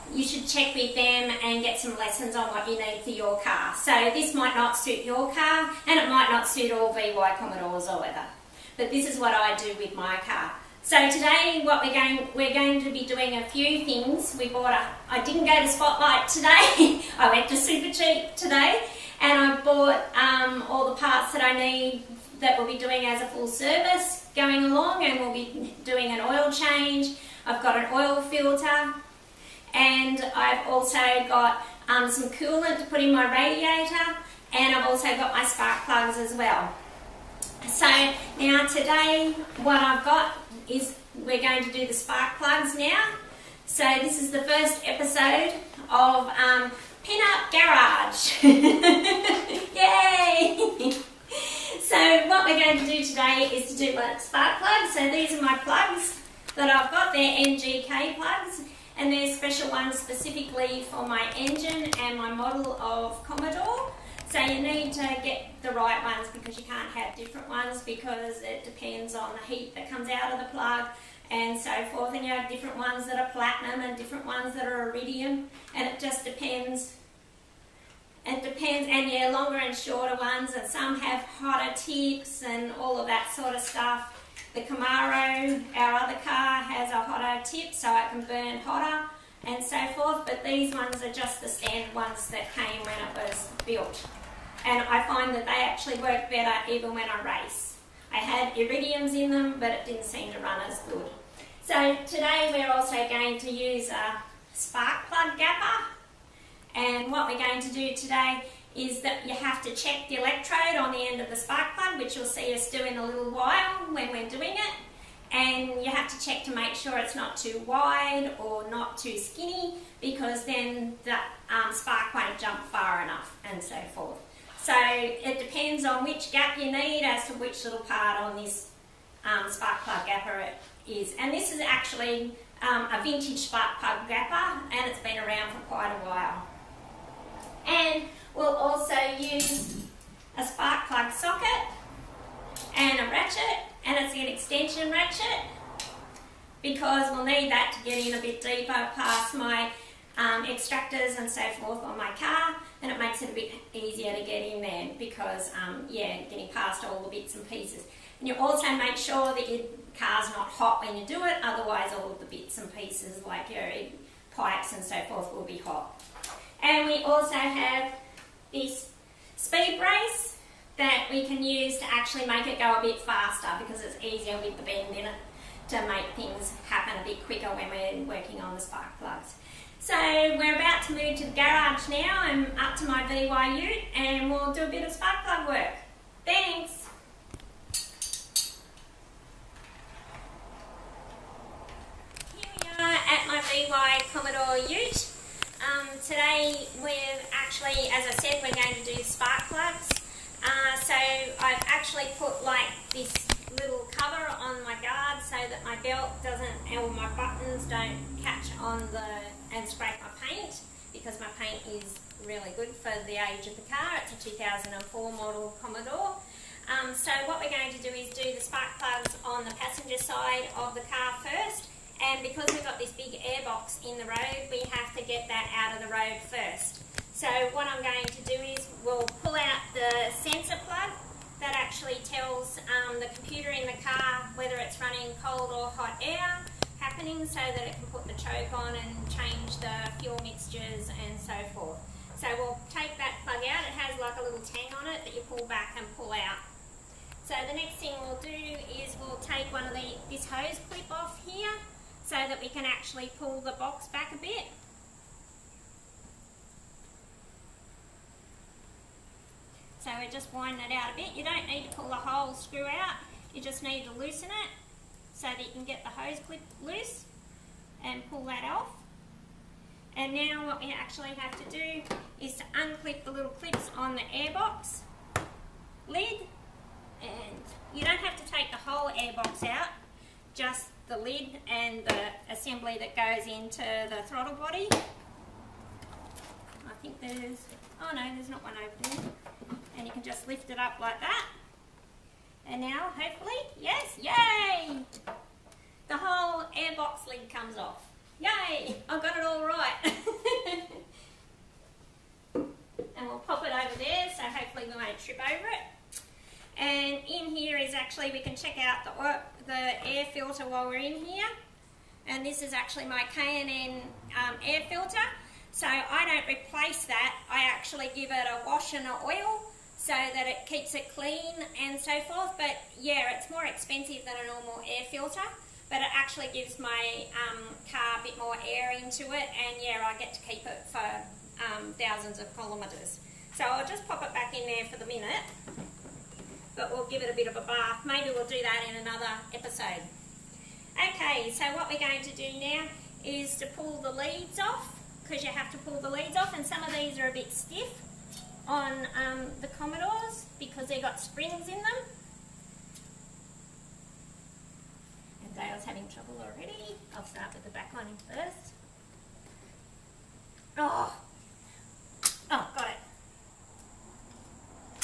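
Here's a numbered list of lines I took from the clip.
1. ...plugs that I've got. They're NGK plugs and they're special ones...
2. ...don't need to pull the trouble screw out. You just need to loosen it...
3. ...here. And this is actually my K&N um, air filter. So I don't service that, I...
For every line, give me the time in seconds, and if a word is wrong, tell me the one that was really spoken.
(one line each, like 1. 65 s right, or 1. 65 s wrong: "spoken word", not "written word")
1. 55 s right
2. 261 s wrong: "whole", not "trouble"
3. 311 s wrong: "replace", not "service".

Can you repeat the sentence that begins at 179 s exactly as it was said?
So we're about to move to the garage now.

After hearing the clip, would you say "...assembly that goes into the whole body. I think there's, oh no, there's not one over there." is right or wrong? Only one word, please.
wrong.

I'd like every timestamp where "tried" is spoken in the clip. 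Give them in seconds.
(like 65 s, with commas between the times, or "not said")
not said.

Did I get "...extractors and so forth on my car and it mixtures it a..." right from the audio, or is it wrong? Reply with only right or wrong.
wrong.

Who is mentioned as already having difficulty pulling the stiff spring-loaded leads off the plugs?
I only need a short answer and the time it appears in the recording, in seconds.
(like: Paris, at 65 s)
Dale, at 355 s.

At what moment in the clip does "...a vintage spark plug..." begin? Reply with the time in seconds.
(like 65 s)
132 s.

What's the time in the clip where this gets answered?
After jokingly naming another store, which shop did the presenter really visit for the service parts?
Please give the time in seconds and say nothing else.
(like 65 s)
17 s.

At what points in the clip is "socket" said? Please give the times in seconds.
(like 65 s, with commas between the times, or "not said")
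141 s.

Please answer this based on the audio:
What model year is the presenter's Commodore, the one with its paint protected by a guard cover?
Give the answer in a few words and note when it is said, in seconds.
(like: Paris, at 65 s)
2004, at 214 s.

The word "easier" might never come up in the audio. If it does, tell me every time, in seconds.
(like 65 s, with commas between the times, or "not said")
153 s, 174 s.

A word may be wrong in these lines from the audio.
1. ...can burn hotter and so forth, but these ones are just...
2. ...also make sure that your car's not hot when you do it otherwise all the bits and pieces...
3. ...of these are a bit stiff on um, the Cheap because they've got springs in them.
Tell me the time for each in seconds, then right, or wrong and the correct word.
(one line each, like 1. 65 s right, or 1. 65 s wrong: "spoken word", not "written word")
1. 88 s right
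2. 158 s right
3. 346 s wrong: "Commodores", not "Cheap".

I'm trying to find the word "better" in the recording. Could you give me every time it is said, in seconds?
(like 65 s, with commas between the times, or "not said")
96 s.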